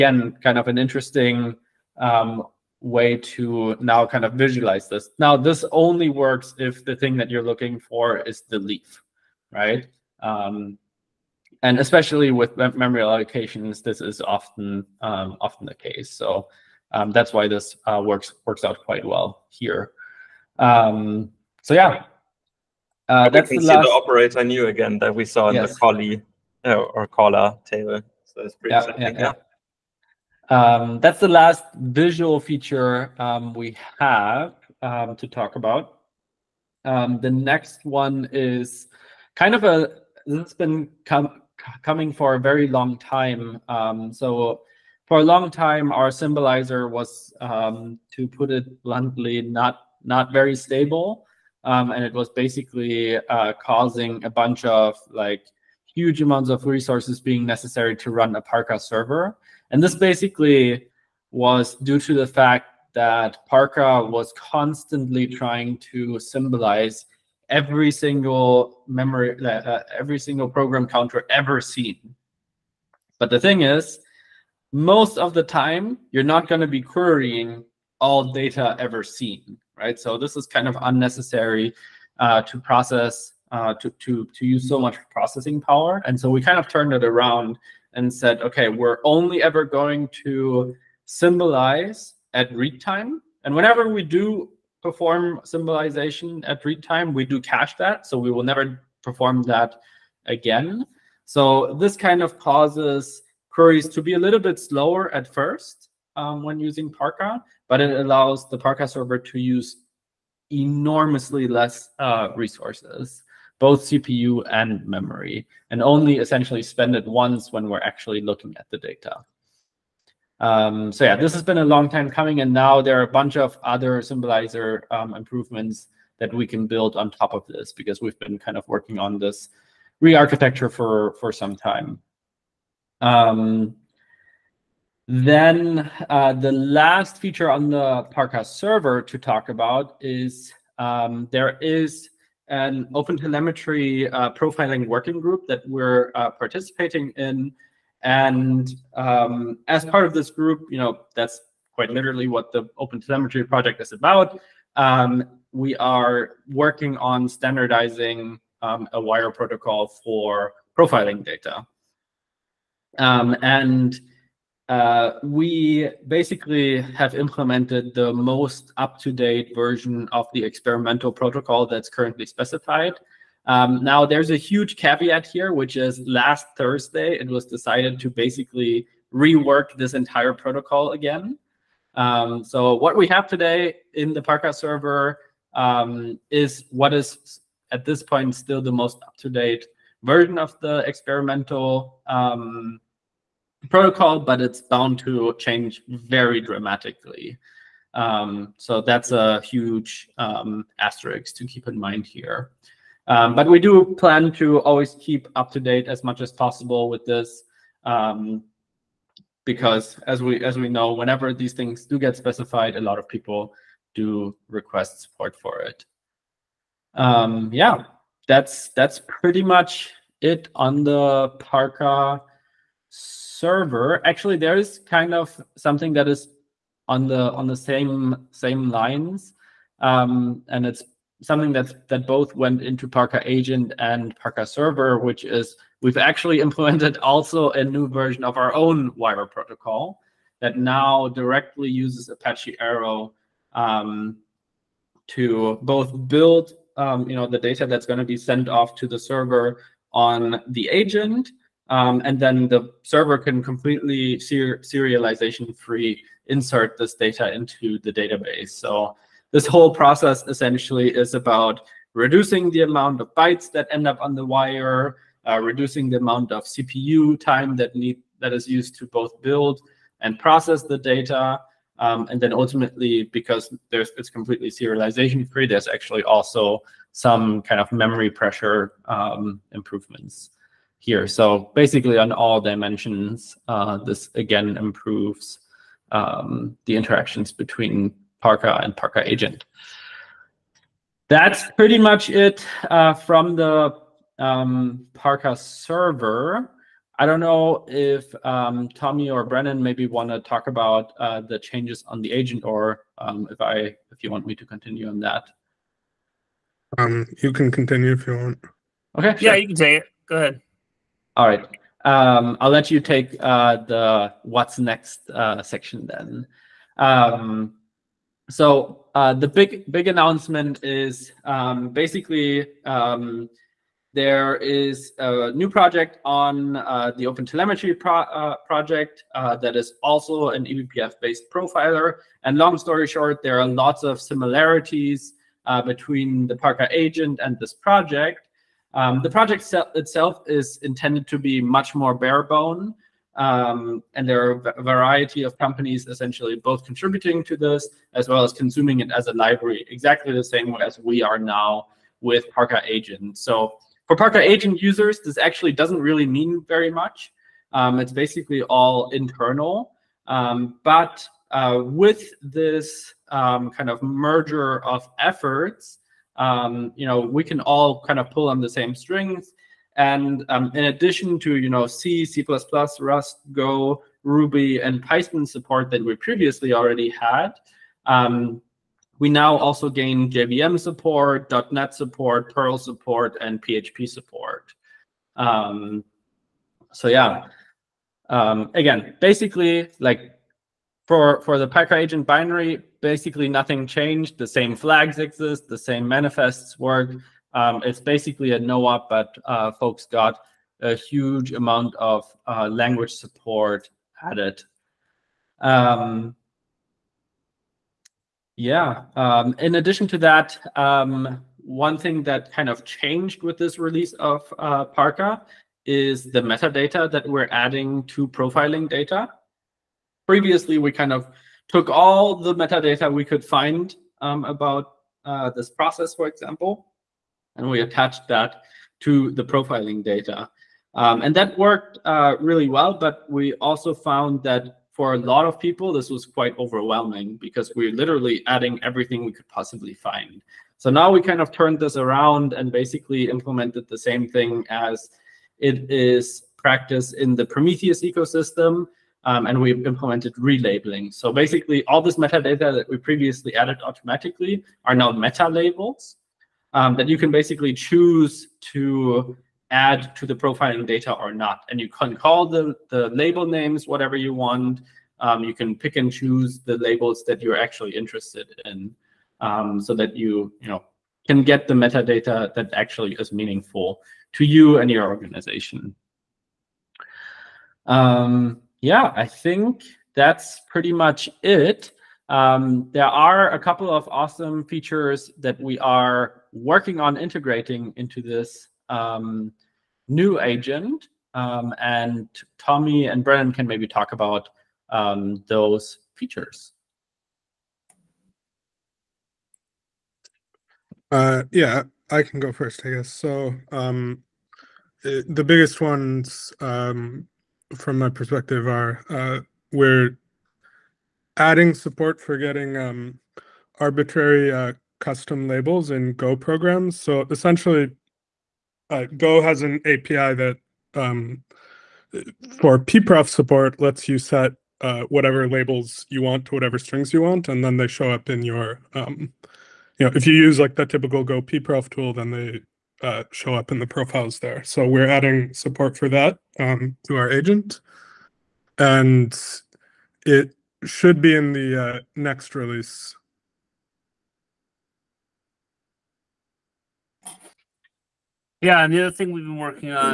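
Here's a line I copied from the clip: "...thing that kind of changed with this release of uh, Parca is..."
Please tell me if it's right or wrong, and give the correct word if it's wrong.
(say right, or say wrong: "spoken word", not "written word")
right.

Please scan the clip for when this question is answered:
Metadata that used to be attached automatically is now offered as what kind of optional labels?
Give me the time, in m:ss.
7:34.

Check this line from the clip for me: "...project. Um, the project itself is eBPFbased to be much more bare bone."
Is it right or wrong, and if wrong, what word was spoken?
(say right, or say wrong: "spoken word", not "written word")
wrong: "intended", not "eBPFbased".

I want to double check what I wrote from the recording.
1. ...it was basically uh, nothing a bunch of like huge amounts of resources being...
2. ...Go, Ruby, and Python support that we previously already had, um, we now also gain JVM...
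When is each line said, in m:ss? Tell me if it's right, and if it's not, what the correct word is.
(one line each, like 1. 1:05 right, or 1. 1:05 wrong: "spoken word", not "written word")
1. 0:52 wrong: "causing", not "nothing"
2. 6:13 right.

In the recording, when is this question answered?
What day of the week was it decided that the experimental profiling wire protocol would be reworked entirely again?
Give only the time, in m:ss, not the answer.
2:56.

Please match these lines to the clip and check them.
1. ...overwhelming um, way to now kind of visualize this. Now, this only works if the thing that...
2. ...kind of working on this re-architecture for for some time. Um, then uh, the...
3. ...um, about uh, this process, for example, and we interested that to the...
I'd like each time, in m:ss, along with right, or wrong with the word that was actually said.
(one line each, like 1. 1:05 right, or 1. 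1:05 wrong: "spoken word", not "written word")
1. 0:00 wrong: "interesting", not "overwhelming"
2. 2:08 right
3. 7:04 wrong: "attached", not "interested".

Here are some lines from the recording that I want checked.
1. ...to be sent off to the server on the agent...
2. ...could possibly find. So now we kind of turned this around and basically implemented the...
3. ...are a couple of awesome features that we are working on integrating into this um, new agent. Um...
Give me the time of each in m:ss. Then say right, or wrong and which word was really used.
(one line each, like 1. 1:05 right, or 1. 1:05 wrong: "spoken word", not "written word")
1. 4:07 right
2. 7:19 right
3. 8:02 right.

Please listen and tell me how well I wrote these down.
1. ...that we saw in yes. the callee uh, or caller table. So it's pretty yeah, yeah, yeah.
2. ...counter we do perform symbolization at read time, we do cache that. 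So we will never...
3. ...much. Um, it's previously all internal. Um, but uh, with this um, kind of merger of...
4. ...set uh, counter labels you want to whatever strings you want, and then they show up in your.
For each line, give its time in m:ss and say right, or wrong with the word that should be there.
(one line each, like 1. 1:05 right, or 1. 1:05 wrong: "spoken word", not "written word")
1. 0:24 right
2. 1:33 wrong: "whenever", not "counter"
3. 5:56 wrong: "basically", not "previously"
4. 8:43 wrong: "whatever", not "counter".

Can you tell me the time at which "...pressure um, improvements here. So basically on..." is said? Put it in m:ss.
4:38.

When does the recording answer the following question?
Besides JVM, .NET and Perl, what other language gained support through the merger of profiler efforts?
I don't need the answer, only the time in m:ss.
6:23.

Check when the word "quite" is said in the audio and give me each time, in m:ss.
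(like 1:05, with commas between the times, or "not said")
0:18, 2:31, 7:16.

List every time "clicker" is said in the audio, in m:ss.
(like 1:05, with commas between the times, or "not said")
not said.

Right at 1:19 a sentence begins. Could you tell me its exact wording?
So this is kind of unnecessary uh, to process, uh, to, to, to use so much processing power.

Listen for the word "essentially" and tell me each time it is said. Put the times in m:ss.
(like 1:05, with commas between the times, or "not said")
1:56, 4:20, 5:45, 8:37.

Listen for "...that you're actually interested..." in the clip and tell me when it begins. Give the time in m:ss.
7:47.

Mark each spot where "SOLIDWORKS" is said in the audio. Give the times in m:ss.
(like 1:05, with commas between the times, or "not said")
not said.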